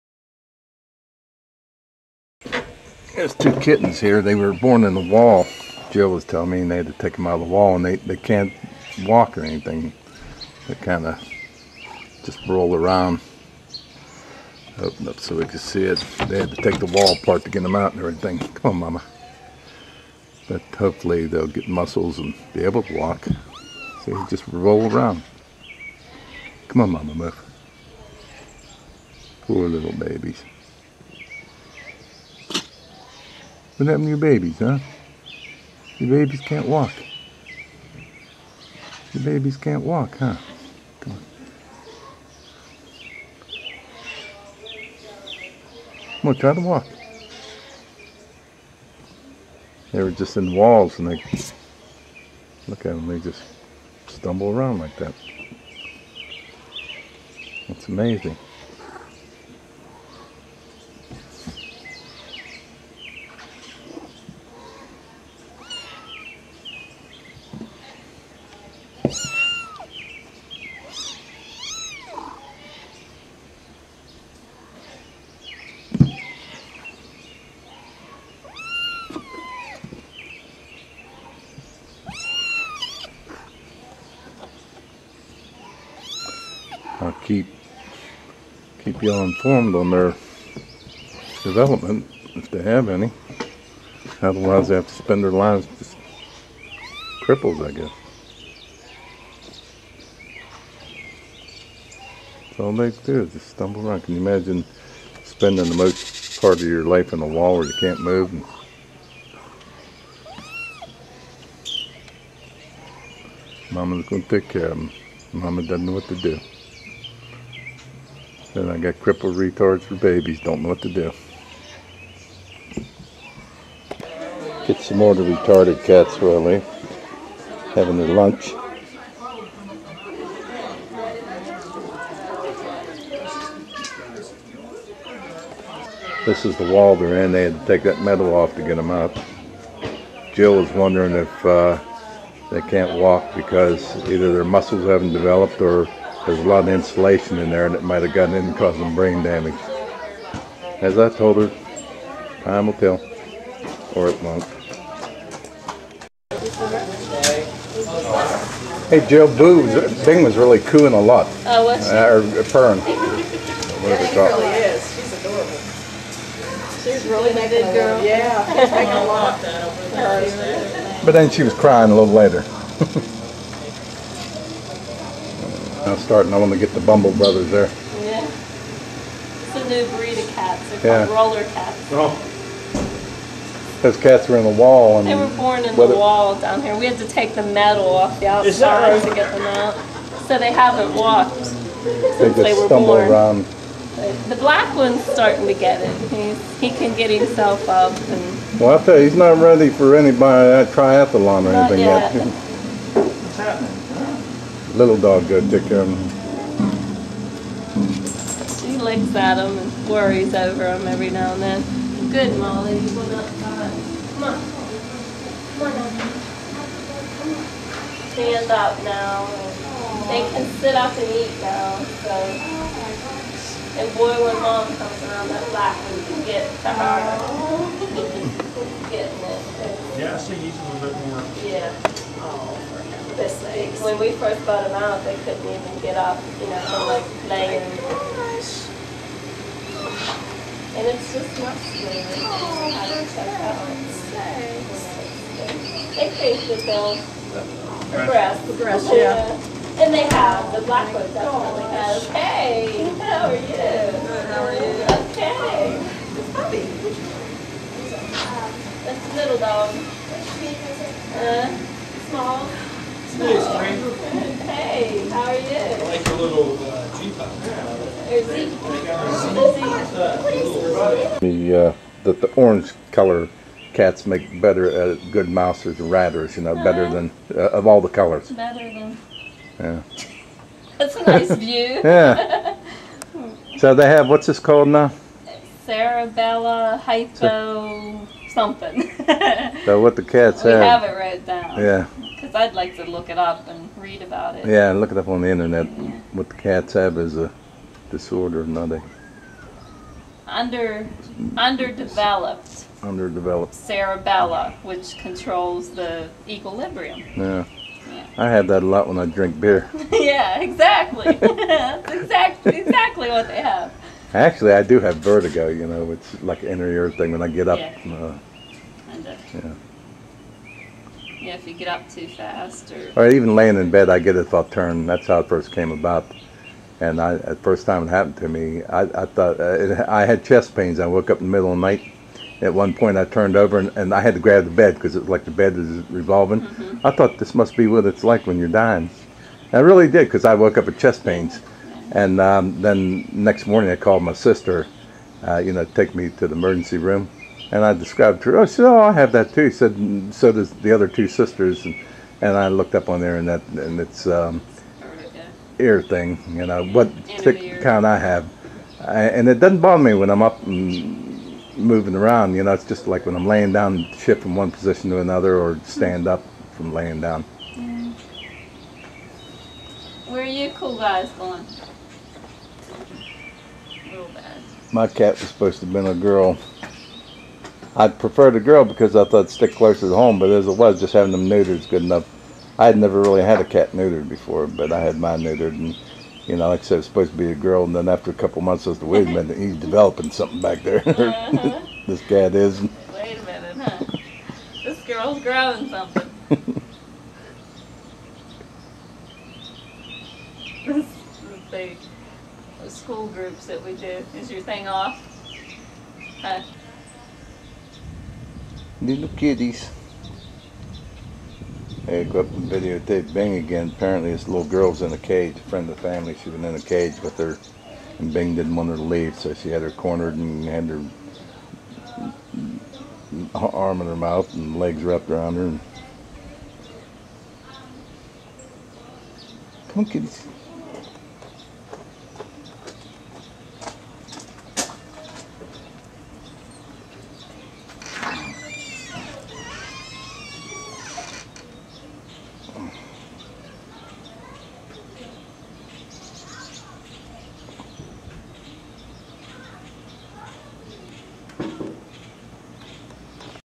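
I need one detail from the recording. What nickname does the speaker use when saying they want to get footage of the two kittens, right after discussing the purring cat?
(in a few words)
Bumble Brothers.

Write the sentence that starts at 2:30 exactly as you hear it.
As I told her, time will tell, or it won't.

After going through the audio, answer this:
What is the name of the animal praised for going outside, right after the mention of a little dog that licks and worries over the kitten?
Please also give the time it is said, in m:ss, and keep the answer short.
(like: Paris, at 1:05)
Molly, at 3:32.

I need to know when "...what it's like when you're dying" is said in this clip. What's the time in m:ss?
5:37.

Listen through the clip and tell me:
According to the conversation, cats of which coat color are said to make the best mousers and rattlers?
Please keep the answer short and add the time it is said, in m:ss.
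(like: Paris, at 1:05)
orange, at 4:32.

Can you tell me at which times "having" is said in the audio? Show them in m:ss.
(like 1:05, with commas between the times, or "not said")
2:07, 6:20.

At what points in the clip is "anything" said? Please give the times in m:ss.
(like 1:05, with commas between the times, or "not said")
0:09, 3:21.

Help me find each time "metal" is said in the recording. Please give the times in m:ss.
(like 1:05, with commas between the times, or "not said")
2:18, 3:07.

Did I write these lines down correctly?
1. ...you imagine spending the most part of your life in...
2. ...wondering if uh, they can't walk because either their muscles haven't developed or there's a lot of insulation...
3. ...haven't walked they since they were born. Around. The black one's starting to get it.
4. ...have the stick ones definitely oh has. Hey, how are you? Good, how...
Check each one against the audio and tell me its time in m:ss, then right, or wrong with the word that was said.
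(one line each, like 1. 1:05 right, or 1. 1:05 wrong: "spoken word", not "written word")
1. 1:44 right
2. 2:20 right
3. 3:10 right
4. 4:10 wrong: "black", not "stick".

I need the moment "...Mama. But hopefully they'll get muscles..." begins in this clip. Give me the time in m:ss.
0:18.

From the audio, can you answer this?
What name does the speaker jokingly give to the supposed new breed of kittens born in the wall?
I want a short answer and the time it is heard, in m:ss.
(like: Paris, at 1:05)
roller cats, at 3:01.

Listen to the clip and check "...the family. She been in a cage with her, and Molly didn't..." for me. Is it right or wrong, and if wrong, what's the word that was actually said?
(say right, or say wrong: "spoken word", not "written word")
wrong: "Bing", not "Molly".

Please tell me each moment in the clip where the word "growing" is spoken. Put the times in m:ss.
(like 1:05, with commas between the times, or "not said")
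6:35.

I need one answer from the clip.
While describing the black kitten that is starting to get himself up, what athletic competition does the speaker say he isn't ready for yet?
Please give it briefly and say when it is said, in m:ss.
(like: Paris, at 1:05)
triathlon, at 3:20.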